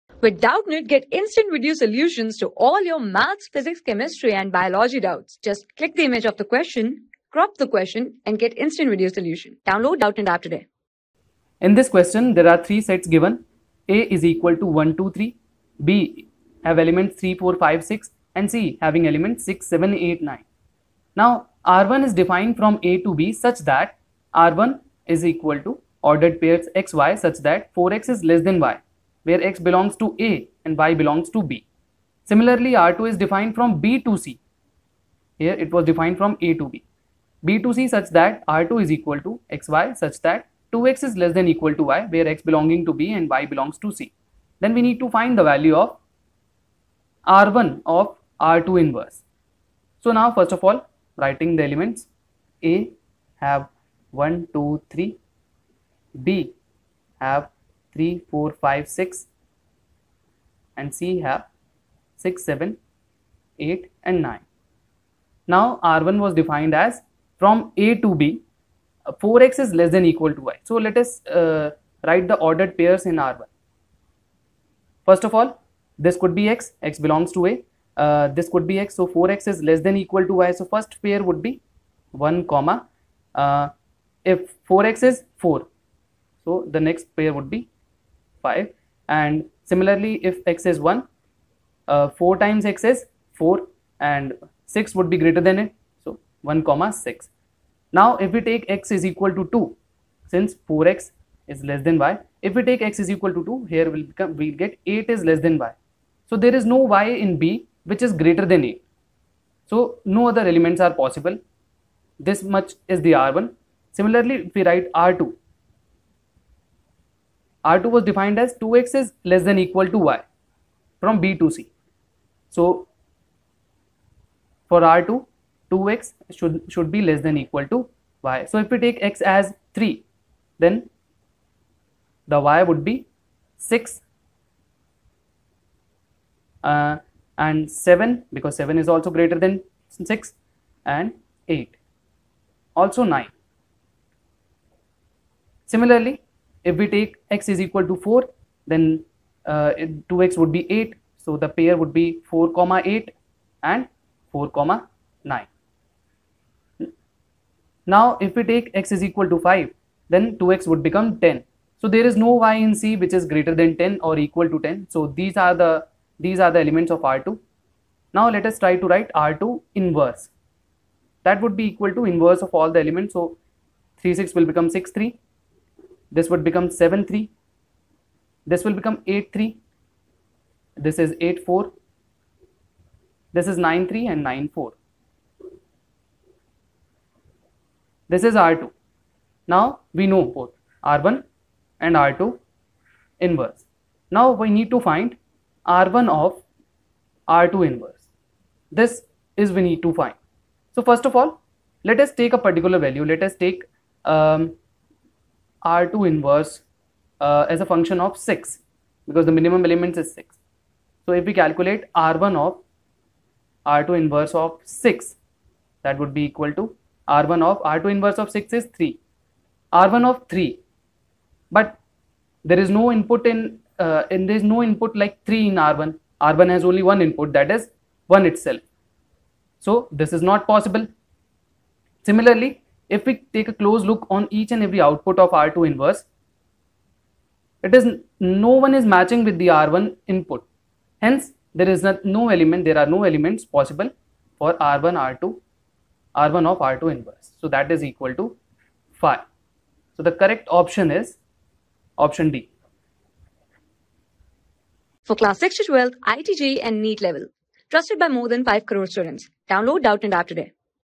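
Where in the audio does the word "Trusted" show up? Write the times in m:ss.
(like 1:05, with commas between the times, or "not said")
4:17.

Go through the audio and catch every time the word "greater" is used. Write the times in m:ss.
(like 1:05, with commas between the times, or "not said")
1:35, 1:48, 2:19, 2:43.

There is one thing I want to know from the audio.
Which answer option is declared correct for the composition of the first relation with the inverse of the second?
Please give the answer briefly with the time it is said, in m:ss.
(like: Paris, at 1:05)
Option D, at 4:11.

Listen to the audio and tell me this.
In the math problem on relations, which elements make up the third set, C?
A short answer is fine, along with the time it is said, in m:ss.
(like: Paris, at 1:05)
6, 7, 8, 9, at 0:19.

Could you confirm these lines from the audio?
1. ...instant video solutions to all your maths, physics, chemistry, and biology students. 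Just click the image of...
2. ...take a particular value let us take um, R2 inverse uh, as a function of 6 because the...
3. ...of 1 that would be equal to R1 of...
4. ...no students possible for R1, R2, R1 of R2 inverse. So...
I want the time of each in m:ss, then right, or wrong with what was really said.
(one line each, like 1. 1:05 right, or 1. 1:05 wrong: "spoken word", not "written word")
1. 0:01 wrong: "doubts", not "students"
2. 3:22 right
3. 3:34 wrong: "6", not "1"
4. 4:02 wrong: "elements", not "students".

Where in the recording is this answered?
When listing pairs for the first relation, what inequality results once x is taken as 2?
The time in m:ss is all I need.
1:44.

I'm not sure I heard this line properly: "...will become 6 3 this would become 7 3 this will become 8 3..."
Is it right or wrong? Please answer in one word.
right.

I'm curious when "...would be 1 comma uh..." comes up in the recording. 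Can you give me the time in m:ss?
1:21.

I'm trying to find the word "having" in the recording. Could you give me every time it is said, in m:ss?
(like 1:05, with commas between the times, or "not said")
0:18.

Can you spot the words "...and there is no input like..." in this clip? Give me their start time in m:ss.
3:44.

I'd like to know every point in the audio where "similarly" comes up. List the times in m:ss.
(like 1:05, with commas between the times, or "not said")
0:32, 1:29, 1:53, 2:25, 3:52.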